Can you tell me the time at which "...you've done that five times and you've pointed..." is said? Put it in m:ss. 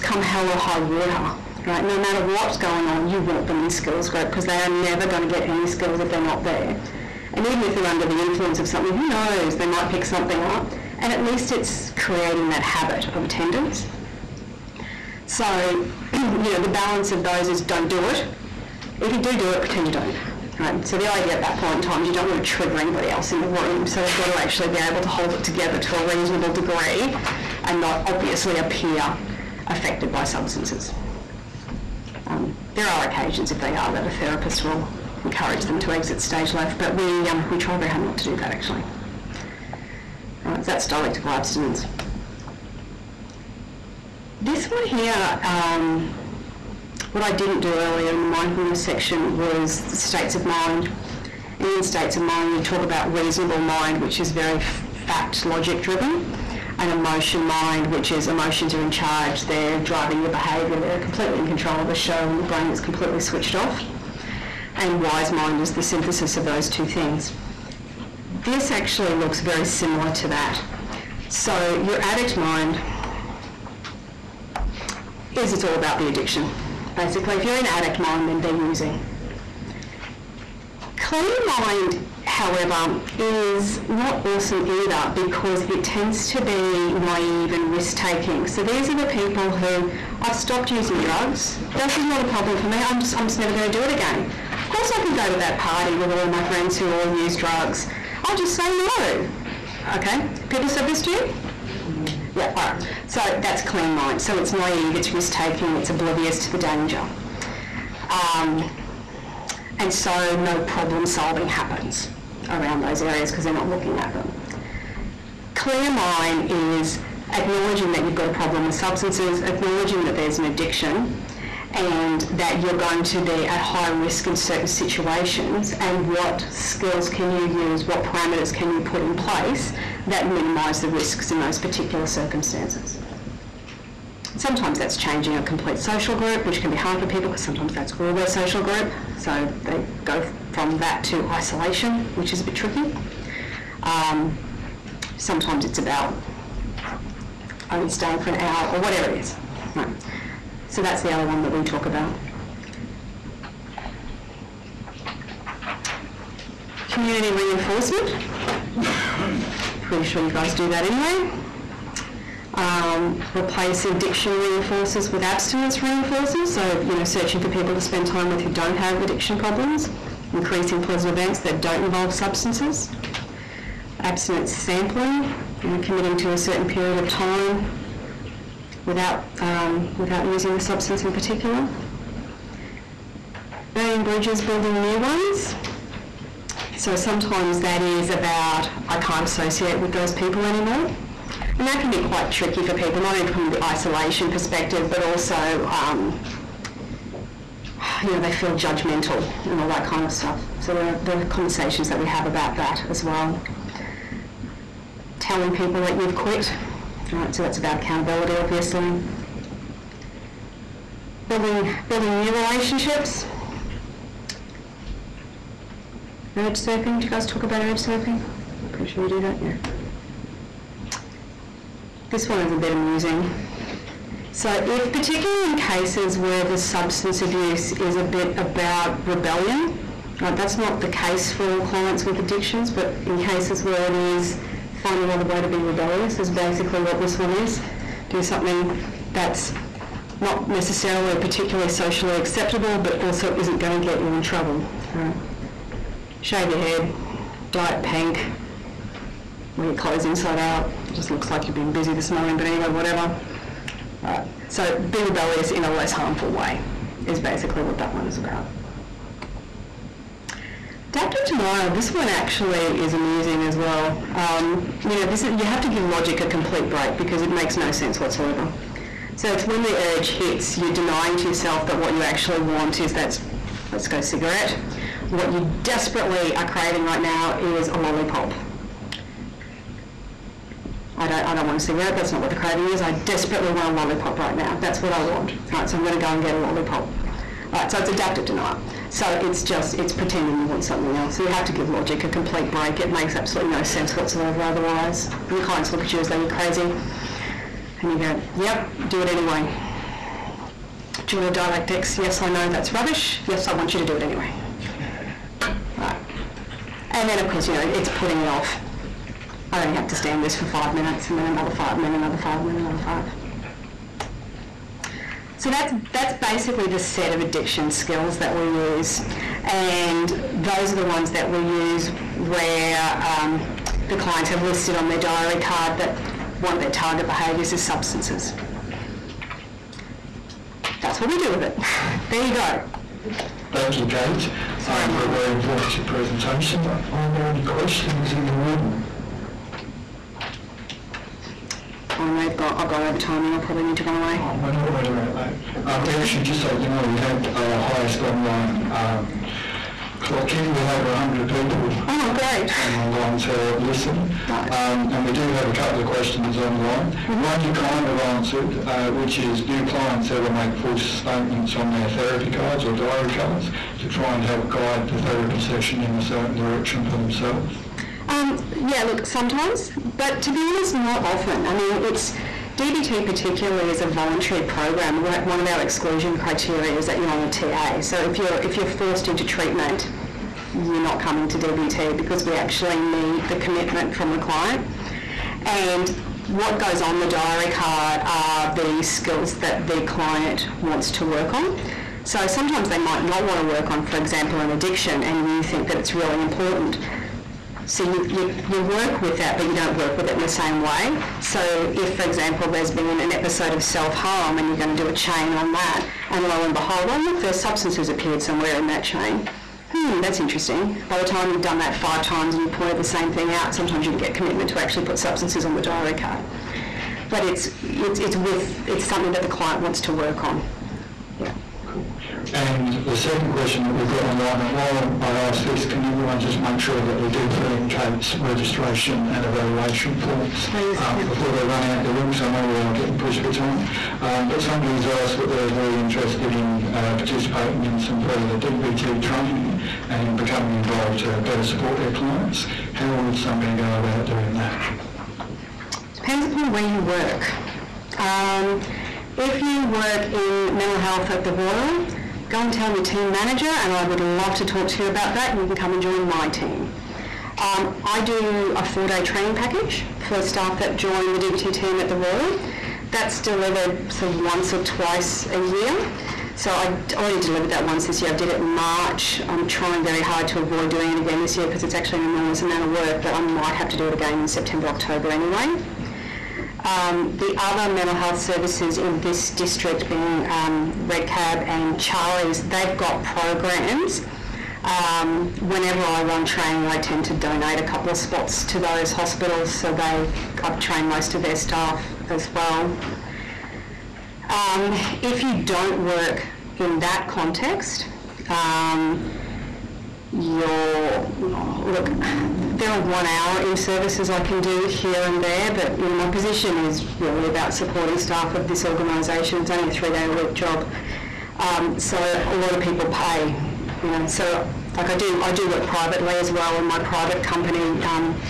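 6:51.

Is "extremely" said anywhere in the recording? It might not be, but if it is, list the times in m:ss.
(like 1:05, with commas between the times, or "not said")
not said.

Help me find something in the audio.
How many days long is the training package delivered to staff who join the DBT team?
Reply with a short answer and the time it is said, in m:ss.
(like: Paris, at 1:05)
4 days, at 7:38.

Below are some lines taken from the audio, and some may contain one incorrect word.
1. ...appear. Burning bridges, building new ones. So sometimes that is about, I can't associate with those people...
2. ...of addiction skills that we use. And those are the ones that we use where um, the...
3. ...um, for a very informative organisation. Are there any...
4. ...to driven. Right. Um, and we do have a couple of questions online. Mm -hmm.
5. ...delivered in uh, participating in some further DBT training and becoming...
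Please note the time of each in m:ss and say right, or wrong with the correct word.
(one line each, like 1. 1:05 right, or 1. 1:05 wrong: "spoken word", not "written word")
1. 3:01 wrong: "particular", not "appear"
2. 5:17 right
3. 5:34 wrong: "presentation", not "organisation"
4. 5:53 wrong: "listen", not "driven"
5. 7:15 wrong: "interested", not "delivered".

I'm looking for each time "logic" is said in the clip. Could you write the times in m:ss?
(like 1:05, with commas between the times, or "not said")
0:55, 4:25, 4:51.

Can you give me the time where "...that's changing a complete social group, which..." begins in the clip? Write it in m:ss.
2:14.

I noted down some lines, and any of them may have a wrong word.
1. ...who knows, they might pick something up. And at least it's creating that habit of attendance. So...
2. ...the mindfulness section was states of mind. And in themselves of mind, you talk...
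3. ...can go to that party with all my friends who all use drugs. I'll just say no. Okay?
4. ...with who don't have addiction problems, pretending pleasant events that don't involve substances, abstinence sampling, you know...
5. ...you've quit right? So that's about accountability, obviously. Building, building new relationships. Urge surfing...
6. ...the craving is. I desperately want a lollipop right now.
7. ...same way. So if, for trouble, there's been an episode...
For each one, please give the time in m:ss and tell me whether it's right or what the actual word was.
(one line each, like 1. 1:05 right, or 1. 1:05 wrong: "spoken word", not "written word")
1. 0:08 right
2. 0:48 wrong: "states", not "themselves"
3. 1:35 right
4. 2:48 wrong: "increasing", not "pretending"
5. 3:25 right
6. 4:42 right
7. 6:40 wrong: "example", not "trouble".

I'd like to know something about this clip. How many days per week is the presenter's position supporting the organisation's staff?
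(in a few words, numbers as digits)
3 days.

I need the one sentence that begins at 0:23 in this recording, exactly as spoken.
So they've got to actually be able to hold it together to a reasonable degree and not obviously appear affected by substances.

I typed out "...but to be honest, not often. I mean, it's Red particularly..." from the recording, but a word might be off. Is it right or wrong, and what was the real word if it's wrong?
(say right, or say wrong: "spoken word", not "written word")
wrong: "DBT", not "Red".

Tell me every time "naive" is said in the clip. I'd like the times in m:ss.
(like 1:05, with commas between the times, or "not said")
1:26, 1:44.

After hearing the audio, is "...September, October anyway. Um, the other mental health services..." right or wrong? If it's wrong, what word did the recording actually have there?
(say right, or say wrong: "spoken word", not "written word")
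right.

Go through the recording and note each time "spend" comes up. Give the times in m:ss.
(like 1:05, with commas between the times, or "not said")
2:47.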